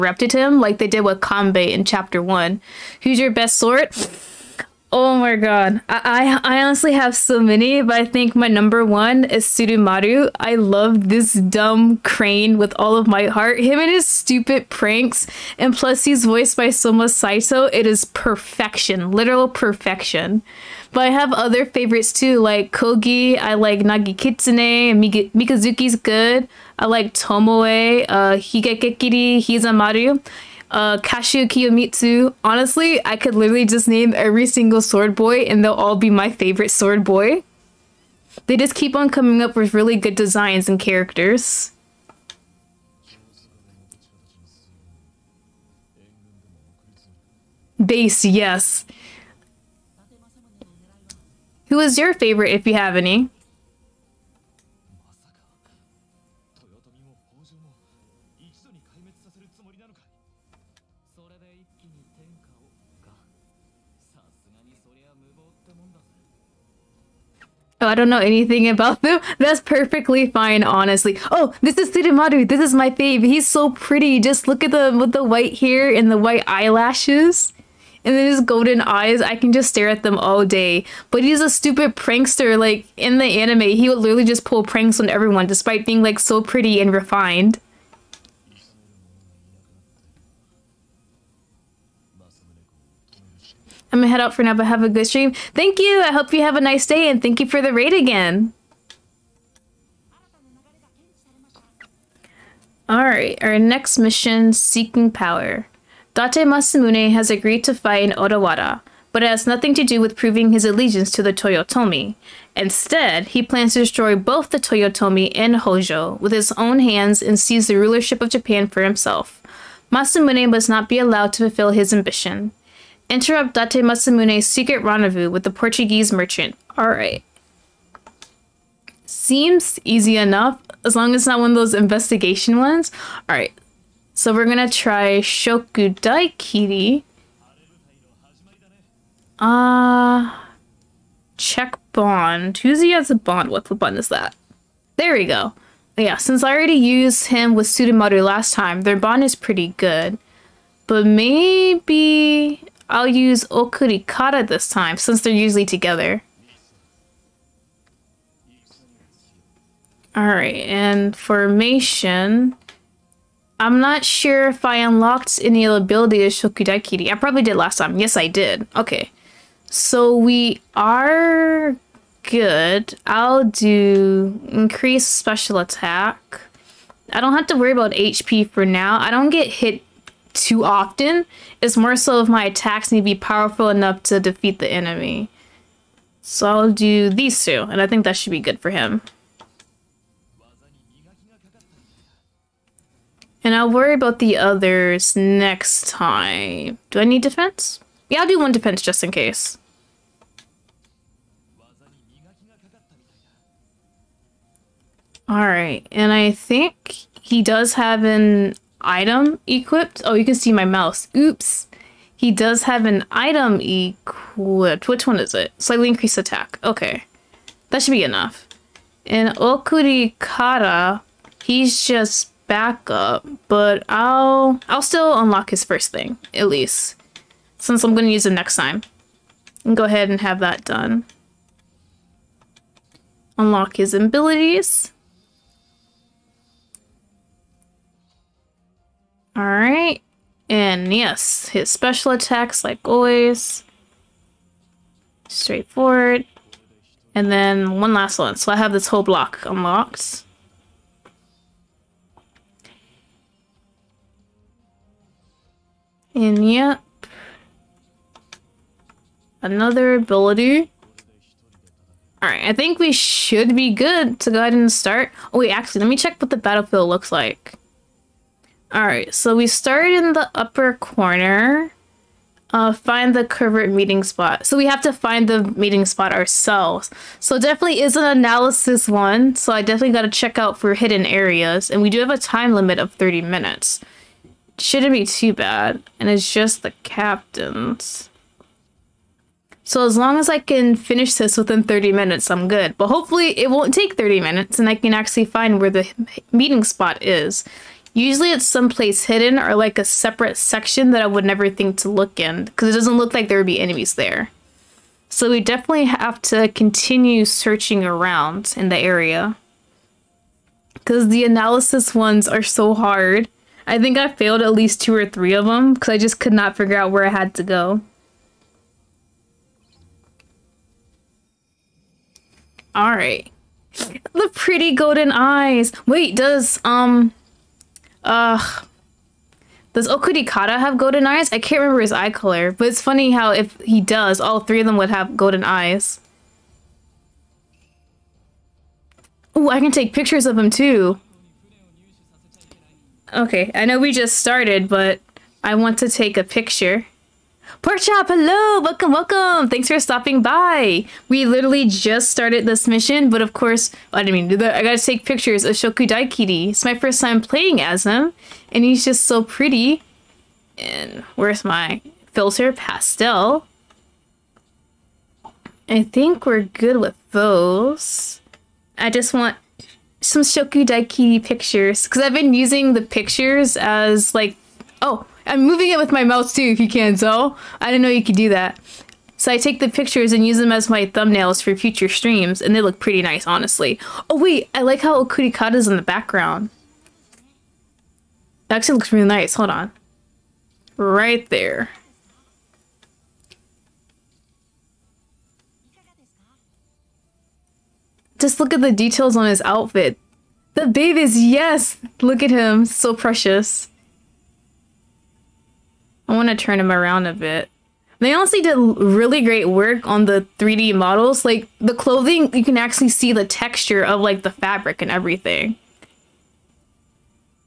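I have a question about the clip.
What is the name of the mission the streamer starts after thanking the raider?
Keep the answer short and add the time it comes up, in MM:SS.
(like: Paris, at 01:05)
Seeking Power, at 01:44.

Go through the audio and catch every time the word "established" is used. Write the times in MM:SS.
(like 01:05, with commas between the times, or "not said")
not said.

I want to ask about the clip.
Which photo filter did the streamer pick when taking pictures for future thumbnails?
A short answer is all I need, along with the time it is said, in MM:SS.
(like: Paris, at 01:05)
Pastel, at 06:02.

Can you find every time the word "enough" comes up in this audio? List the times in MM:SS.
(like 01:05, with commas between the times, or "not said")
02:10, 03:03, 03:38.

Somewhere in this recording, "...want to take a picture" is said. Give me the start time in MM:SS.
05:45.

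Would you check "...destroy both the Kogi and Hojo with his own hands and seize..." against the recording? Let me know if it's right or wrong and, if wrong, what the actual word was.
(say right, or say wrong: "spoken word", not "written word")
wrong: "Toyotomi", not "Kogi".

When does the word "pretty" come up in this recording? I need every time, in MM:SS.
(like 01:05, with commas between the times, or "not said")
01:13, 01:26, 02:29, 05:24, 05:59, 06:22.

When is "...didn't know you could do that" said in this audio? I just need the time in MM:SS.
06:17.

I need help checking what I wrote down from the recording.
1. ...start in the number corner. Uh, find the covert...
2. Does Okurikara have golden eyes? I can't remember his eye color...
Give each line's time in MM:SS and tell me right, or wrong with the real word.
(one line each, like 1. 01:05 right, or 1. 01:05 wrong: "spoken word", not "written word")
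1. 04:29 wrong: "upper", not "number"
2. 05:29 right.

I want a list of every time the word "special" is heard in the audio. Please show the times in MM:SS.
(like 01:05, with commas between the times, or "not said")
02:55, 04:01.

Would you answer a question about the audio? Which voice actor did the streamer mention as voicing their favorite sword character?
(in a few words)
Soma Saito.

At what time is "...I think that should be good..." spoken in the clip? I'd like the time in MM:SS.
03:07.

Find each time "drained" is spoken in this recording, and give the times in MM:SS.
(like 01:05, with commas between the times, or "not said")
not said.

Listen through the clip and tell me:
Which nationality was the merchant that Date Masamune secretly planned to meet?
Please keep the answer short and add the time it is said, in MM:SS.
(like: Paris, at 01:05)
Portuguese, at 02:05.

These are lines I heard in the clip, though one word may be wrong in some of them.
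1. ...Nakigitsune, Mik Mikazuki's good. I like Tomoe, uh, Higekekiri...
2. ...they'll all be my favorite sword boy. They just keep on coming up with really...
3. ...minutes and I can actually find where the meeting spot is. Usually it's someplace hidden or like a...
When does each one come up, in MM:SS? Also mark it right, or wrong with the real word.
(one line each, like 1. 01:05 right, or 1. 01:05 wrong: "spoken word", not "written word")
1. 00:23 right
2. 00:35 right
3. 04:54 right.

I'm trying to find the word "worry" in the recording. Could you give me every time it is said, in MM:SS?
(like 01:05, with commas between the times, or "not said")
02:57, 03:13.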